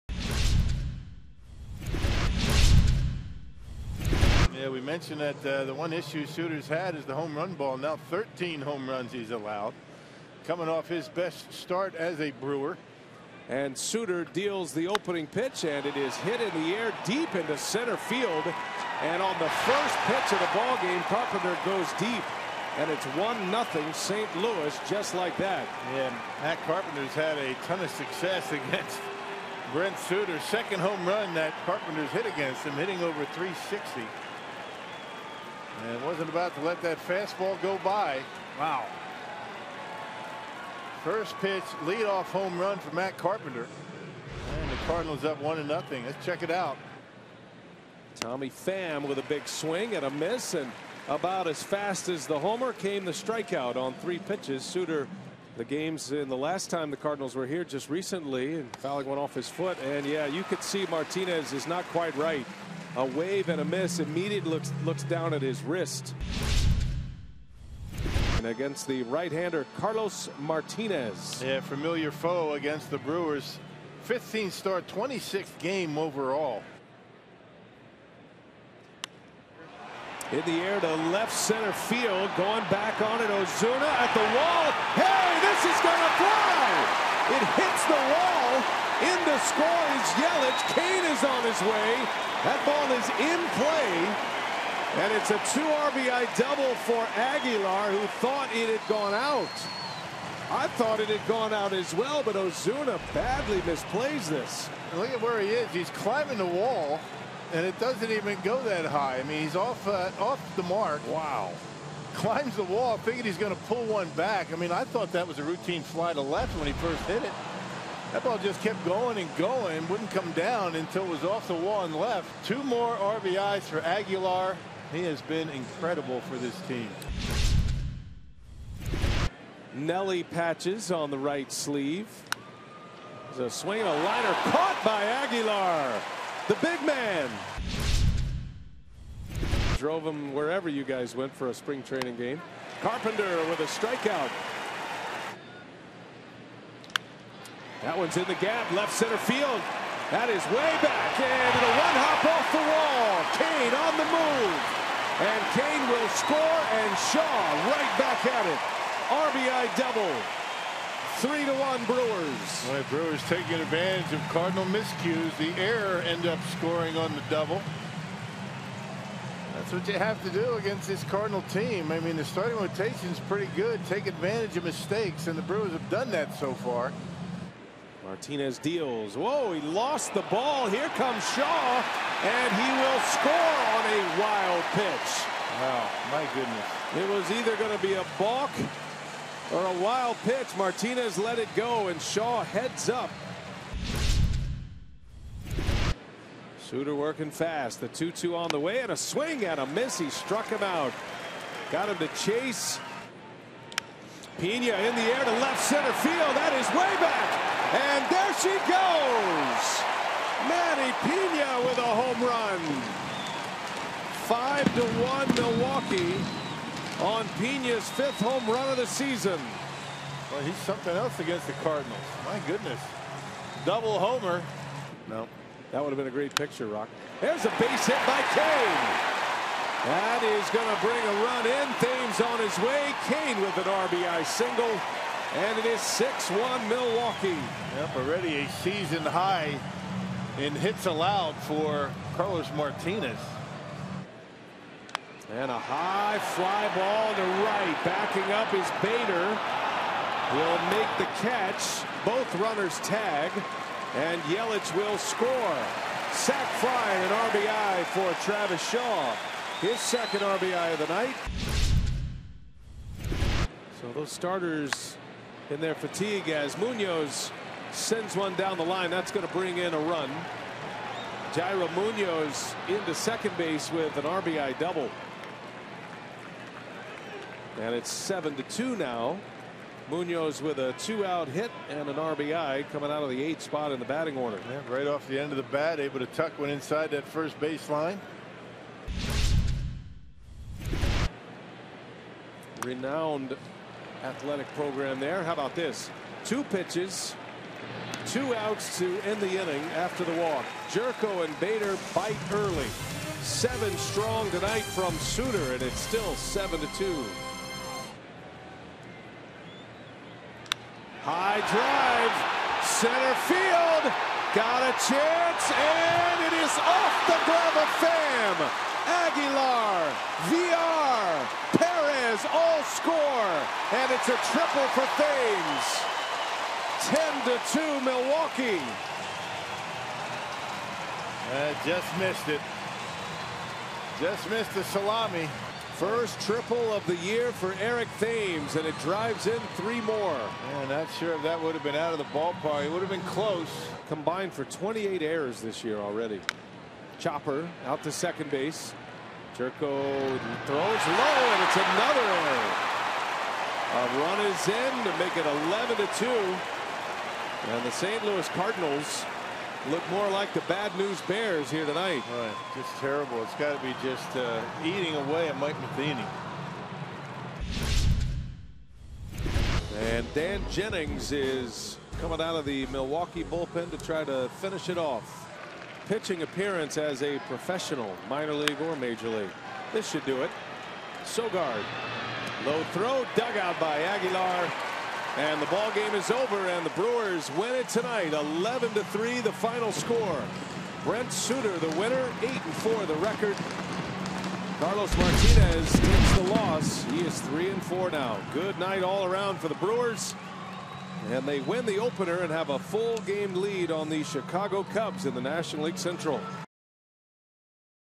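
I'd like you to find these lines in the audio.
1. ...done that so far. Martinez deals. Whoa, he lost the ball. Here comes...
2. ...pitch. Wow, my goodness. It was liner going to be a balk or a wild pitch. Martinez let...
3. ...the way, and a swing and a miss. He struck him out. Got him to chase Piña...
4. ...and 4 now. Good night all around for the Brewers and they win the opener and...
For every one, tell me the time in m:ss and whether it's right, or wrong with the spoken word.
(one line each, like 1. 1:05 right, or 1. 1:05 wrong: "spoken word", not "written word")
1. 2:55 right
2. 3:04 wrong: "either", not "liner"
3. 3:18 right
4. 6:37 right.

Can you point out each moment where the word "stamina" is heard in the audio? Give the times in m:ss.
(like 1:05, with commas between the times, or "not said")
not said.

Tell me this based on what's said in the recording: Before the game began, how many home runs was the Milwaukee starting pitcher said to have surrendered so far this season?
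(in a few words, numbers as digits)
13.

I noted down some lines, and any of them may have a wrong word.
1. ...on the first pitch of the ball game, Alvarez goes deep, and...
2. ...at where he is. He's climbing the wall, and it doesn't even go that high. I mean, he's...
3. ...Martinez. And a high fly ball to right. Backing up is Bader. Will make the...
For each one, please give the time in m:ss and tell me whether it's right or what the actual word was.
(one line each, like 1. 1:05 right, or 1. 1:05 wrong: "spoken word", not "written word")
1. 0:19 wrong: "Carpenter", not "Alvarez"
2. 1:45 right
3. 4:02 right.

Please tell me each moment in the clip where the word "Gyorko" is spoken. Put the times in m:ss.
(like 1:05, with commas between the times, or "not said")
5:00, 5:49.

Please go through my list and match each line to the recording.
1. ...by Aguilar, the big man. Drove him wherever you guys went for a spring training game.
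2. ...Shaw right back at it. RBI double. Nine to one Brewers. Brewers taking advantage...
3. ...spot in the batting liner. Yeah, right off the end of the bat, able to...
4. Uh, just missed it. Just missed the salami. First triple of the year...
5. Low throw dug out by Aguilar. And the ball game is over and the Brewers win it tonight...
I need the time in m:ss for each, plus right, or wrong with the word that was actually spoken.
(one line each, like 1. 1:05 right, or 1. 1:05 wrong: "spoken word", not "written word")
1. 2:14 right
2. 2:37 wrong: "Three", not "Nine"
3. 4:43 wrong: "order", not "liner"
4. 5:31 right
5. 6:22 right.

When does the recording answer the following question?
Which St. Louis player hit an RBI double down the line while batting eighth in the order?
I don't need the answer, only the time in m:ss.
4:31.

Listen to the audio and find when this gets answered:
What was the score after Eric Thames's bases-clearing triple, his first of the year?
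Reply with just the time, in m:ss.
5:26.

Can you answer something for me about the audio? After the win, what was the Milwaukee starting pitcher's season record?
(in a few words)
8 and 4.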